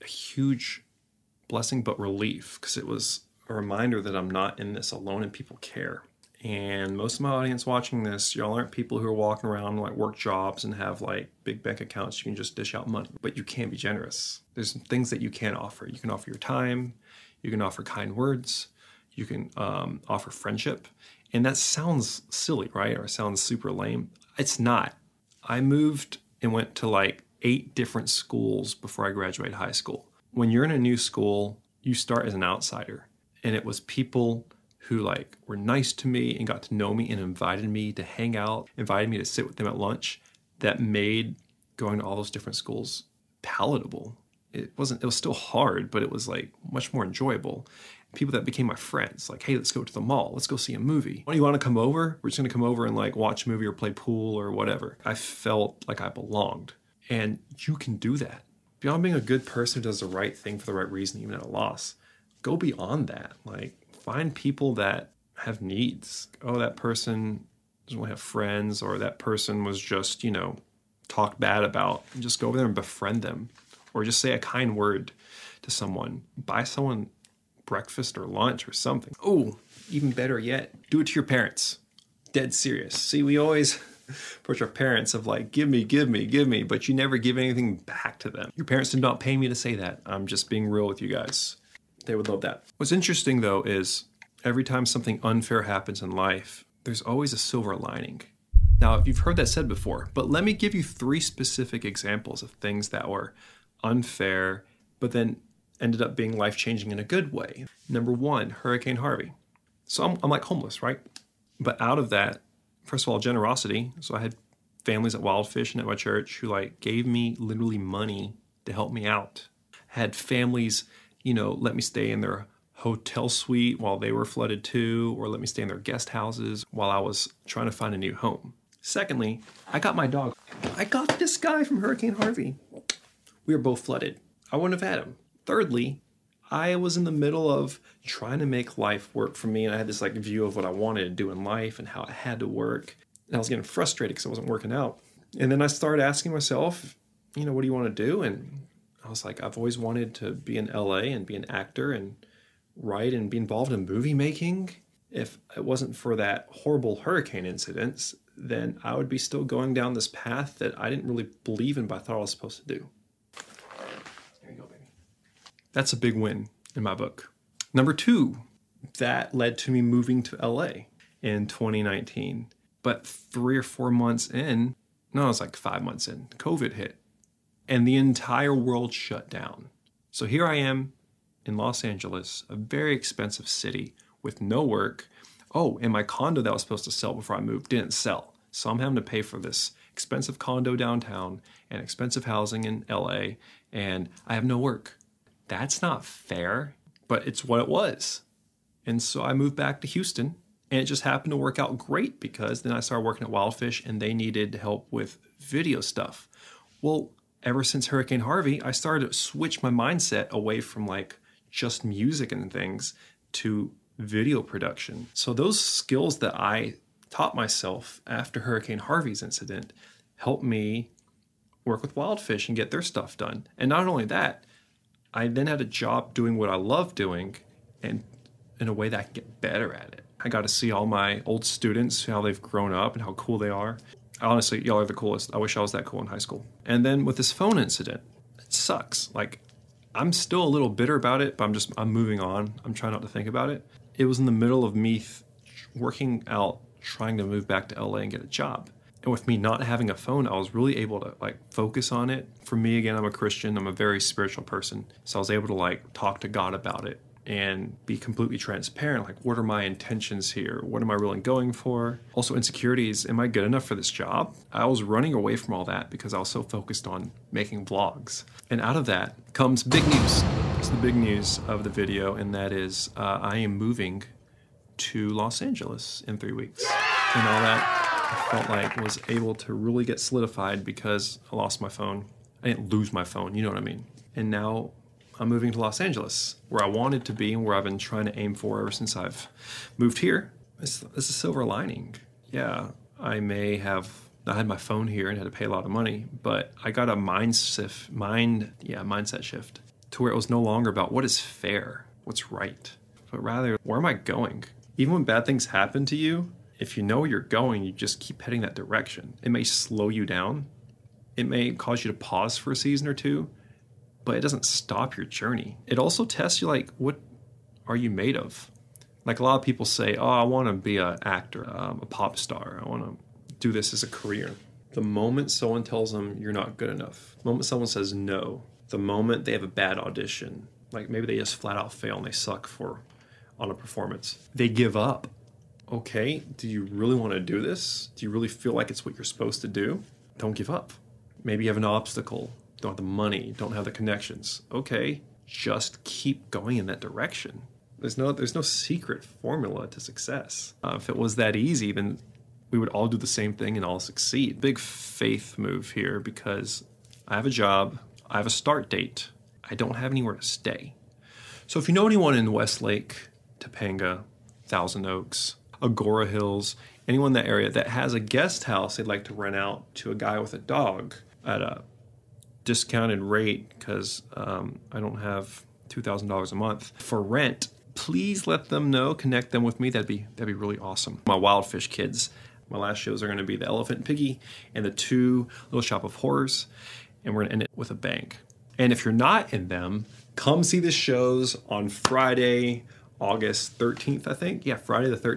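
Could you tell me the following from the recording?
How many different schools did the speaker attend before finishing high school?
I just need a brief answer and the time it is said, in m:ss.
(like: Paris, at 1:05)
8, at 0:27.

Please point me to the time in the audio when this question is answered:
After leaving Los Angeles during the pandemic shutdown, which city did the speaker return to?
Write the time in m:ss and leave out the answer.
3:19.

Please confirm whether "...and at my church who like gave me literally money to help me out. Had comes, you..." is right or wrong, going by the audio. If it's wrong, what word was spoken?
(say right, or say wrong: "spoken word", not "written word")
wrong: "families", not "comes".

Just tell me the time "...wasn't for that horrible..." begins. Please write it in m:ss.
2:35.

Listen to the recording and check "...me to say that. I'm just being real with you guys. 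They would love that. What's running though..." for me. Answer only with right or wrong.
wrong.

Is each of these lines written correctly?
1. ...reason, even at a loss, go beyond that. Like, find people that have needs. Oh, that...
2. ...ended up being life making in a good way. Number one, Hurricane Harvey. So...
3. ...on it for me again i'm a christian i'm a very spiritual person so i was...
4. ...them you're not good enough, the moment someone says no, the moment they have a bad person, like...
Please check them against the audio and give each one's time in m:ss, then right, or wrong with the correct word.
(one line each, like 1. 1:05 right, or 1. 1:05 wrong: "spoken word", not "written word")
1. 1:00 right
2. 1:45 wrong: "changing", not "making"
3. 4:11 right
4. 5:25 wrong: "audition", not "person".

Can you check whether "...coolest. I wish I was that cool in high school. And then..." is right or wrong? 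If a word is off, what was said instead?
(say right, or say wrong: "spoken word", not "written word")
right.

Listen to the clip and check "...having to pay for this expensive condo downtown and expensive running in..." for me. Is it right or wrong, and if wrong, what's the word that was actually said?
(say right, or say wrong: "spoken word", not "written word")
wrong: "housing", not "running".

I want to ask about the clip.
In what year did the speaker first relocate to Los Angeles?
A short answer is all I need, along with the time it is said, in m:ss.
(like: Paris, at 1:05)
2019, at 2:51.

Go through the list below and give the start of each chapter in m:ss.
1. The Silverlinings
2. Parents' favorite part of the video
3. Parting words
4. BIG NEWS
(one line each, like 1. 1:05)
1. 1:34
2. 1:19
3. 6:20
4. 4:29.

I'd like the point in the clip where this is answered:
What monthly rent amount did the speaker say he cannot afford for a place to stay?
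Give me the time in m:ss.
6:15.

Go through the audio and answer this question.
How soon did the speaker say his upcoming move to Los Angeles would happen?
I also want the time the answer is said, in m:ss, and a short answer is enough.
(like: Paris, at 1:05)
3 weeks, at 4:36.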